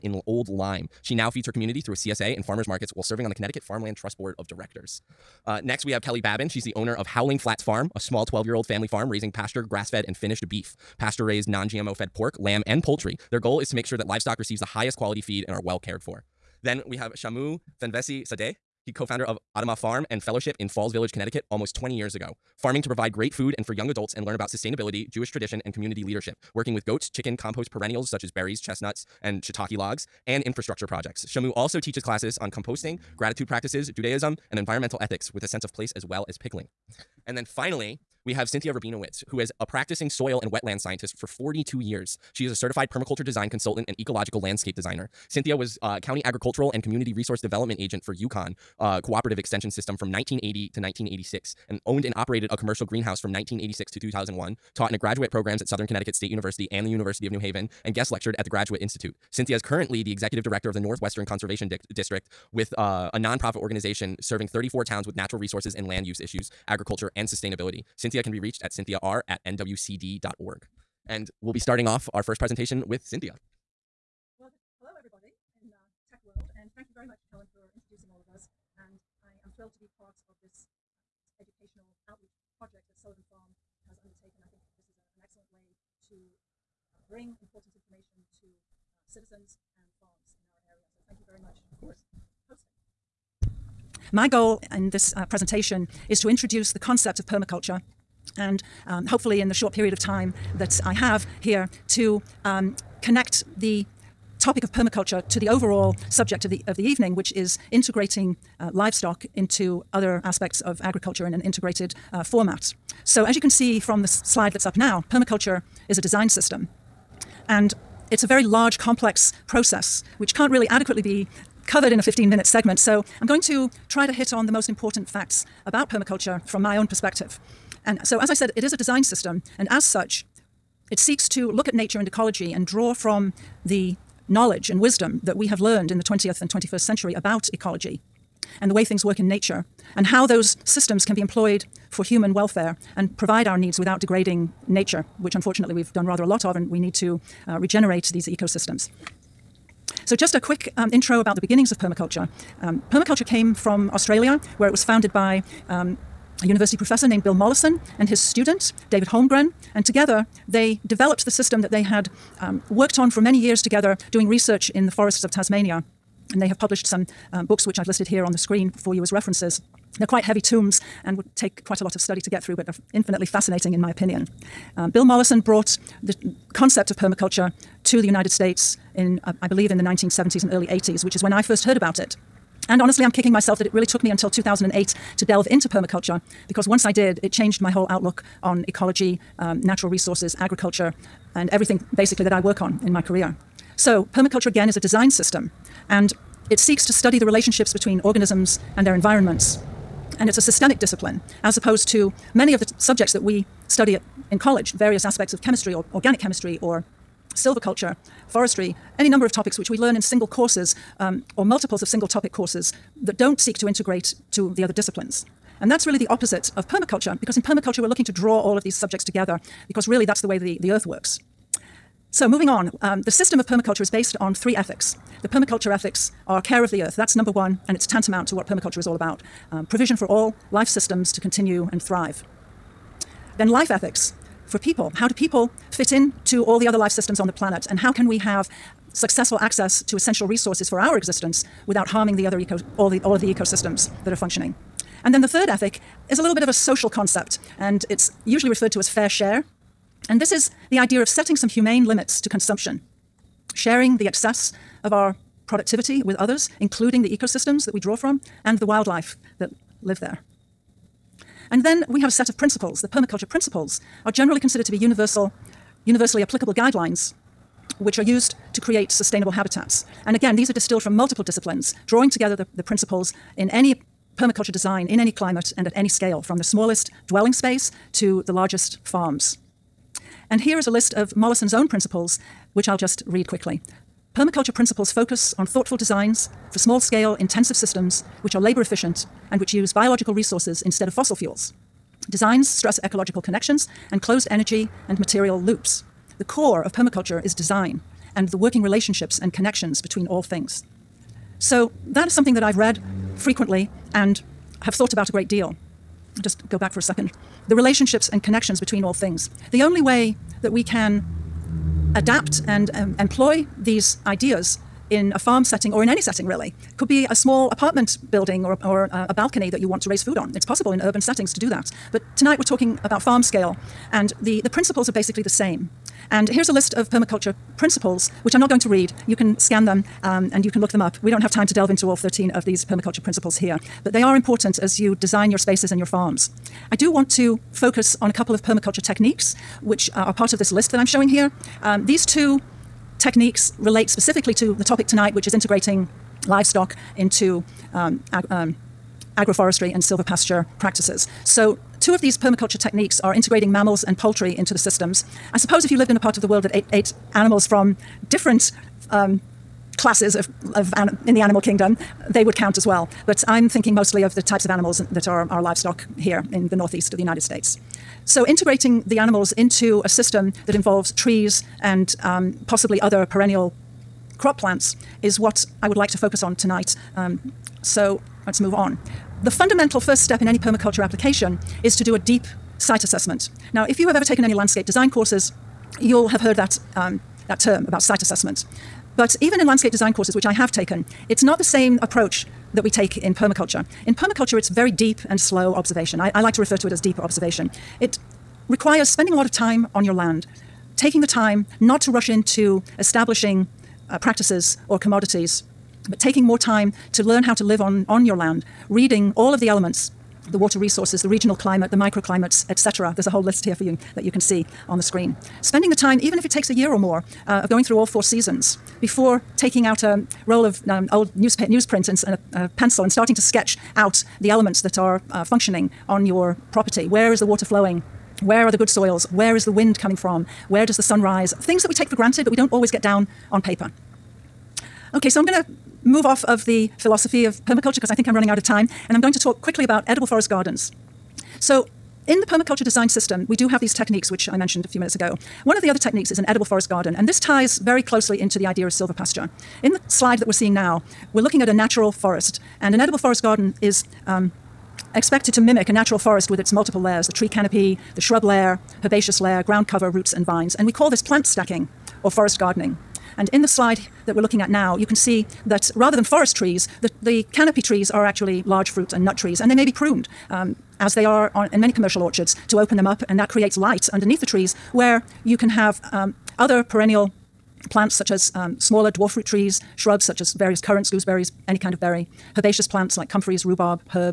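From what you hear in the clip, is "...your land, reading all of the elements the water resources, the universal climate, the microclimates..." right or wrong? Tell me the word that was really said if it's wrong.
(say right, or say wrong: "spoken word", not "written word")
wrong: "regional", not "universal".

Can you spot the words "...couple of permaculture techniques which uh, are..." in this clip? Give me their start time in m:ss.
5:38.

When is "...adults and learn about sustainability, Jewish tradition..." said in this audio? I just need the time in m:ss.
0:23.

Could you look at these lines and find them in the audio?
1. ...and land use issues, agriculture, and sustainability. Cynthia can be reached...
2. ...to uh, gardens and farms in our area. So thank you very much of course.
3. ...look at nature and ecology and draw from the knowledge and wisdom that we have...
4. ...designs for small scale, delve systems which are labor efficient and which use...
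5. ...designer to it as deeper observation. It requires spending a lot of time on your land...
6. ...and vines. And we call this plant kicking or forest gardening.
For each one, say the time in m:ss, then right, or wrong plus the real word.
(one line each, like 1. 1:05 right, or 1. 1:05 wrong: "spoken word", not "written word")
1. 1:05 right
2. 1:28 wrong: "citizens", not "gardens"
3. 2:11 right
4. 4:45 wrong: "intensive", not "delve"
5. 6:36 wrong: "refer", not "designer"
6. 7:40 wrong: "stacking", not "kicking".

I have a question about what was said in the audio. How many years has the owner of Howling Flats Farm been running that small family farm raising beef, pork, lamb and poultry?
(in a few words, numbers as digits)
12.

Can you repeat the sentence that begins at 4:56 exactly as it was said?
The core of permaculture is design and the working relationships and connections between all things.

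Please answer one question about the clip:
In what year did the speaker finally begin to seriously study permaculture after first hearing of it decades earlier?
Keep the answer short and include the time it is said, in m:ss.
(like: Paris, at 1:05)
2008, at 3:04.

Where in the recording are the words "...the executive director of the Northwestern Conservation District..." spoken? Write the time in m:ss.
1:00.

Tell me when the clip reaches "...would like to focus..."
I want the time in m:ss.
6:15.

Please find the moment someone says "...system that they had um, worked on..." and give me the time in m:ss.
2:41.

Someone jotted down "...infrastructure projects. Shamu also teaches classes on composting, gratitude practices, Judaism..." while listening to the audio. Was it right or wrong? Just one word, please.
right.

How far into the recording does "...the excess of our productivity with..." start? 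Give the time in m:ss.
4:13.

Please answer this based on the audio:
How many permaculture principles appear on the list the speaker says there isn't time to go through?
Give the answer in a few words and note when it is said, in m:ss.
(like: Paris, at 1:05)
13, at 5:31.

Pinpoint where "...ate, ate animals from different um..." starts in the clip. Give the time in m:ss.
5:56.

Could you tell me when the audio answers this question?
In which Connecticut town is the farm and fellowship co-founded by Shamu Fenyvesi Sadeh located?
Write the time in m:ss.
0:20.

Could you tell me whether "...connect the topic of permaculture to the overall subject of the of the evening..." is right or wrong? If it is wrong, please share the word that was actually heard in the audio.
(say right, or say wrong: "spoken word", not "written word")
right.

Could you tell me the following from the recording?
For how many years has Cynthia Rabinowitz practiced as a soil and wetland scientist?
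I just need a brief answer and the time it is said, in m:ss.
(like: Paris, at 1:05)
42, at 0:41.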